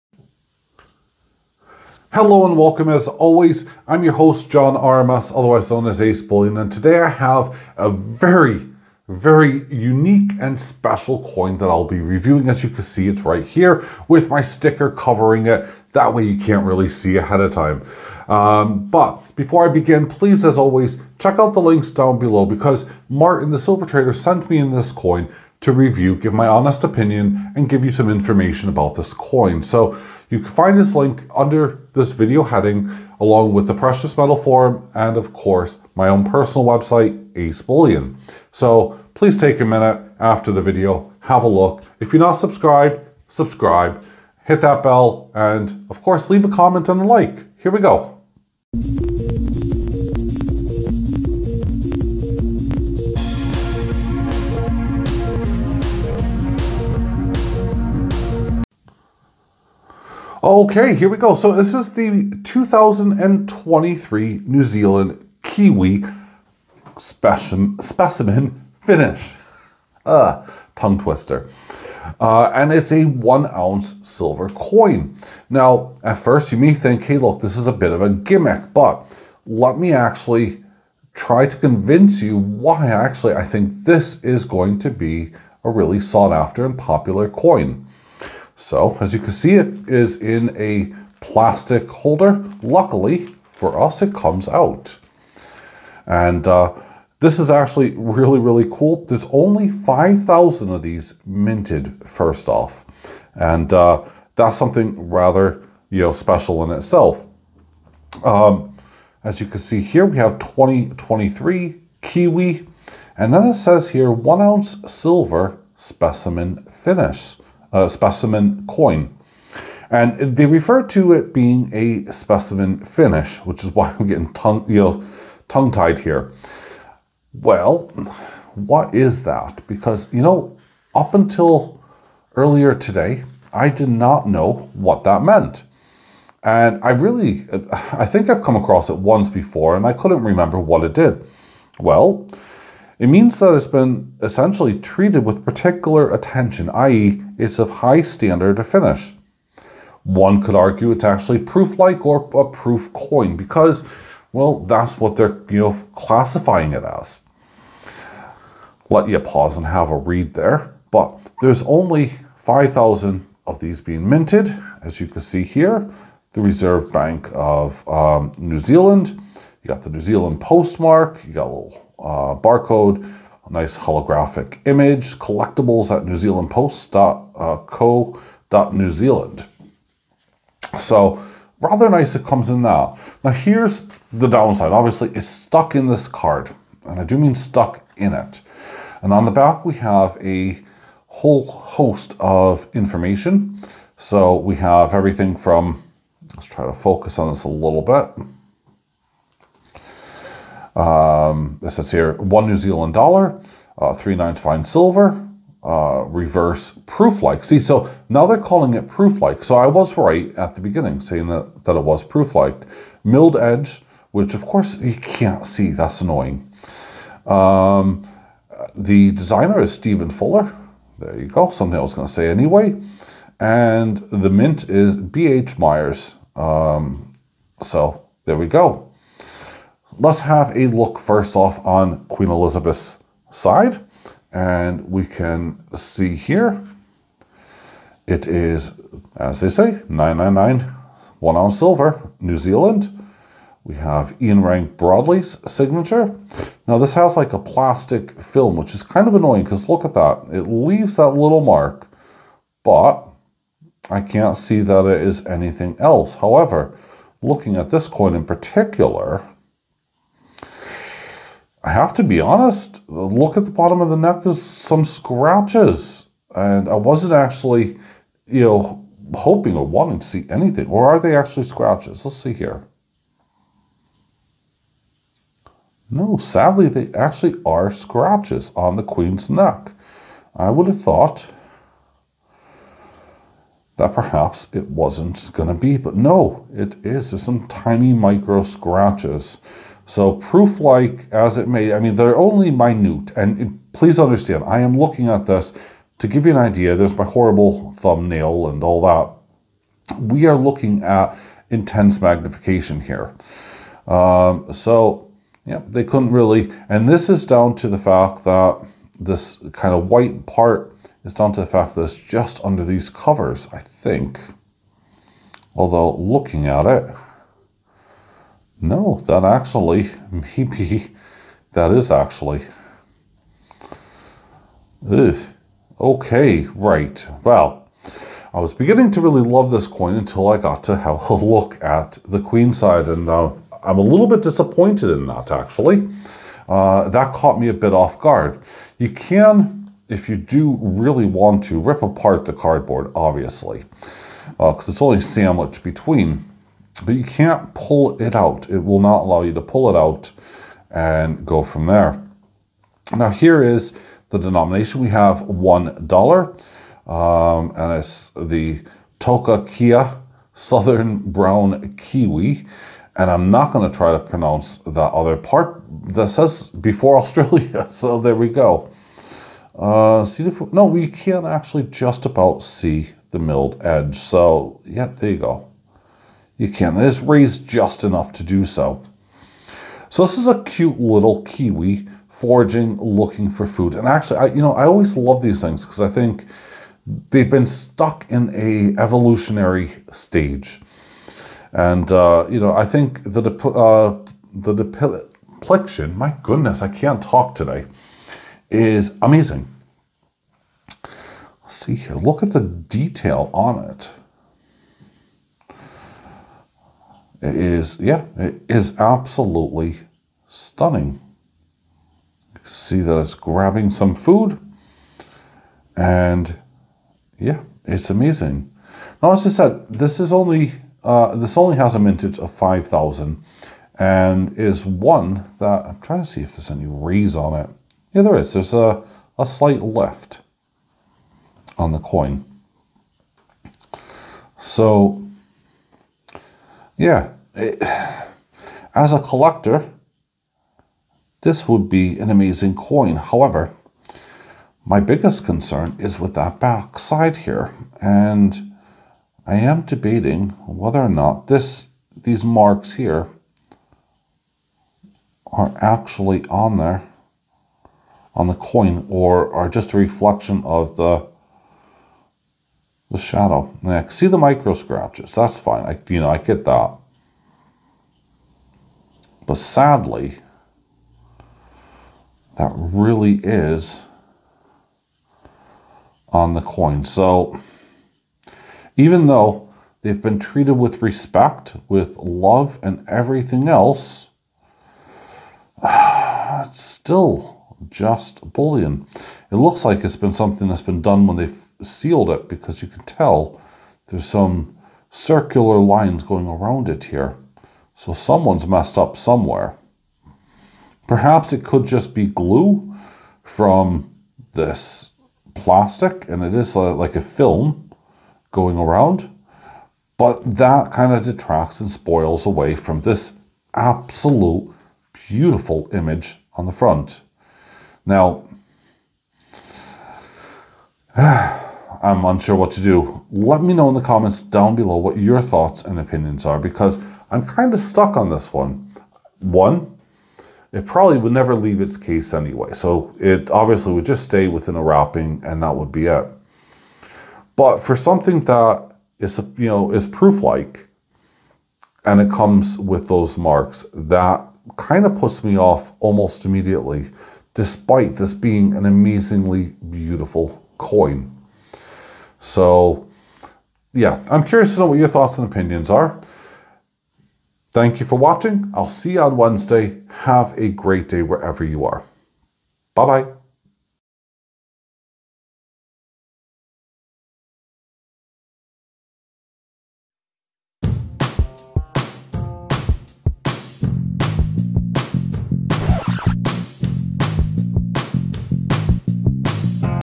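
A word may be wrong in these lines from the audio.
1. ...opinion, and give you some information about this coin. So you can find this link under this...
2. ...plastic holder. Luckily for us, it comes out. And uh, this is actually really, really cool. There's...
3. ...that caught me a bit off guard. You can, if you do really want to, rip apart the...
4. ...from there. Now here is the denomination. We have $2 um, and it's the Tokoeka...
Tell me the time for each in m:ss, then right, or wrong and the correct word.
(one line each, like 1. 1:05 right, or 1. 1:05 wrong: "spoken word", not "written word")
1. 0:26 right
2. 1:31 right
3. 5:36 right
4. 5:51 wrong: "1", not "2".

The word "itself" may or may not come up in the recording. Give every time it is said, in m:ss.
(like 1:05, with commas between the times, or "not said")
1:46.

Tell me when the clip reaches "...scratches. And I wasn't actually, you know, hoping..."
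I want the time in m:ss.
4:24.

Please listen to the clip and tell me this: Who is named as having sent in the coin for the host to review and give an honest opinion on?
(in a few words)
Martin, the silver trader.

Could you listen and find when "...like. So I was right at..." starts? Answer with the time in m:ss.
3:29.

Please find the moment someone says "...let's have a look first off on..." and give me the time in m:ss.
3:50.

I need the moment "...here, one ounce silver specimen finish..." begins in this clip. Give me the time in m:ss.
1:53.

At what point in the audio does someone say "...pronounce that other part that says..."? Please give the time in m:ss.
6:03.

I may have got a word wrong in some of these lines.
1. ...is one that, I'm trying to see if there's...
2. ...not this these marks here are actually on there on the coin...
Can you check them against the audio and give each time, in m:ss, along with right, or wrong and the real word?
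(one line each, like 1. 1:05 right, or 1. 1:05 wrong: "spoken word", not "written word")
1. 7:04 right
2. 7:30 right.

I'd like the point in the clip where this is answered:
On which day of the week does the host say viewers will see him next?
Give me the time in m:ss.
9:19.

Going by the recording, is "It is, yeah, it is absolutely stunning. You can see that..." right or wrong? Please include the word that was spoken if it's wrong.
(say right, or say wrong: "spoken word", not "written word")
right.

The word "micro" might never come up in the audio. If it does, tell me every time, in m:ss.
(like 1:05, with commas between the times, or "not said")
4:47, 7:44.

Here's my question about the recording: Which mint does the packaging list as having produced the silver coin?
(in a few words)
B.H. Mayer's.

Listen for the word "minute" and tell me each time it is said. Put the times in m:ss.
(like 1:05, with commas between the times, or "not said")
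0:39, 4:52.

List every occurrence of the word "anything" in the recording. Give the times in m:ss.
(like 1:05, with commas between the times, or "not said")
4:15, 4:30.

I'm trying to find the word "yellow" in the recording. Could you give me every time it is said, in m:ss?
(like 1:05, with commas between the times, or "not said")
not said.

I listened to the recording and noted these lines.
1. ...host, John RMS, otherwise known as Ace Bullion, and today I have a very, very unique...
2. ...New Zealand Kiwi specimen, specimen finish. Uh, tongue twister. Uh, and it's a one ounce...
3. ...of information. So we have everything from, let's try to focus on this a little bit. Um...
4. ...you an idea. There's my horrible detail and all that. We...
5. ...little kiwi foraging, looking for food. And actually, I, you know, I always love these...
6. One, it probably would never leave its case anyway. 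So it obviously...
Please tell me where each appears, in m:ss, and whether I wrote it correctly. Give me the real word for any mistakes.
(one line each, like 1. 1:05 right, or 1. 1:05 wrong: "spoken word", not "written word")
1. 0:04 right
2. 1:04 right
3. 3:12 right
4. 4:56 wrong: "thumbnail", not "detail"
5. 6:20 right
6. 8:49 right.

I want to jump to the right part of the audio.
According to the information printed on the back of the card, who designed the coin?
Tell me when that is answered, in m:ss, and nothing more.
3:39.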